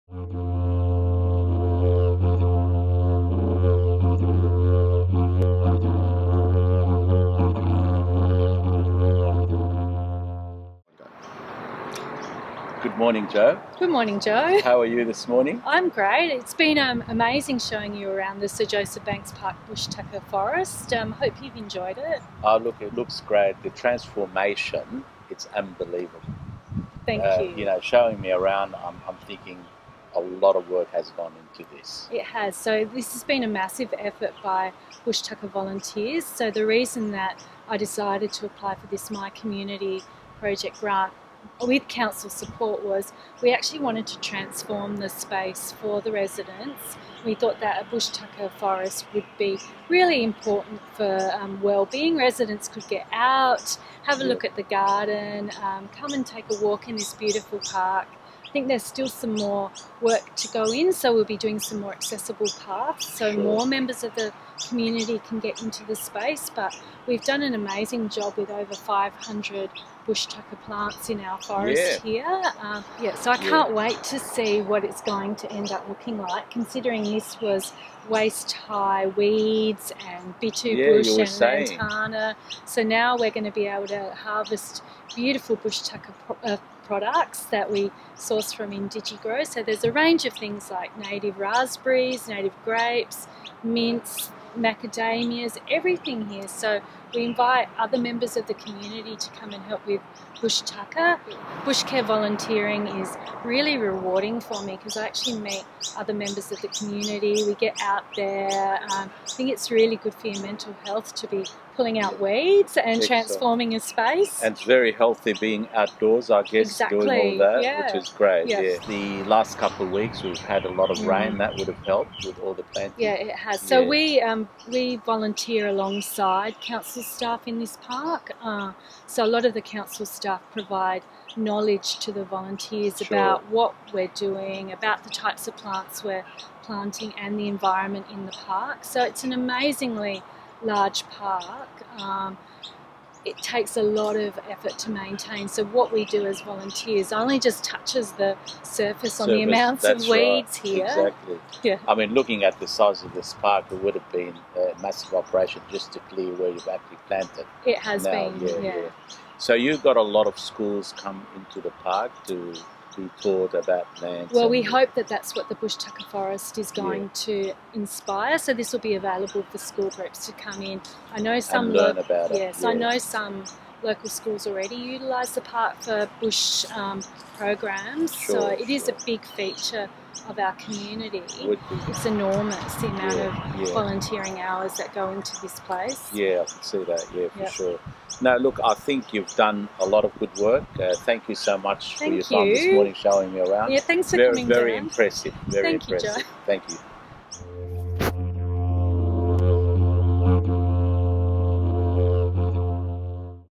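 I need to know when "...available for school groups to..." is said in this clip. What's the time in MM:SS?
02:48.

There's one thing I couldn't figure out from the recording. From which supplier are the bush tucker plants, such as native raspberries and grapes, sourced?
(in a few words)
IndigiGrow.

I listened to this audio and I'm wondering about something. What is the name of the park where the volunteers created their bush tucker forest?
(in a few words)
Sir Joseph Banks Park.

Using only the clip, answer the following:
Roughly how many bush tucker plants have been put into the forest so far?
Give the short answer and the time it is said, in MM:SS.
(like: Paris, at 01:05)
500, at 01:08.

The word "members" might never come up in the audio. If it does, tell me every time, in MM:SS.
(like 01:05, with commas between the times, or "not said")
01:03, 01:37, 01:46.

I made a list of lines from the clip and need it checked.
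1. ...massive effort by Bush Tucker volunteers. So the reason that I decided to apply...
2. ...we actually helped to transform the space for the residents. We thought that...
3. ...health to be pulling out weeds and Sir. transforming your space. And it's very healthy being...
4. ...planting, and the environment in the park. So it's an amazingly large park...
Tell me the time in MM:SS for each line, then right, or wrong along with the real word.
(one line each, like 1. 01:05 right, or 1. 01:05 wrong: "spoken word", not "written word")
1. 00:33 right
2. 00:43 wrong: "wanted", not "helped"
3. 01:50 wrong: "Excellent", not "Sir"
4. 02:16 right.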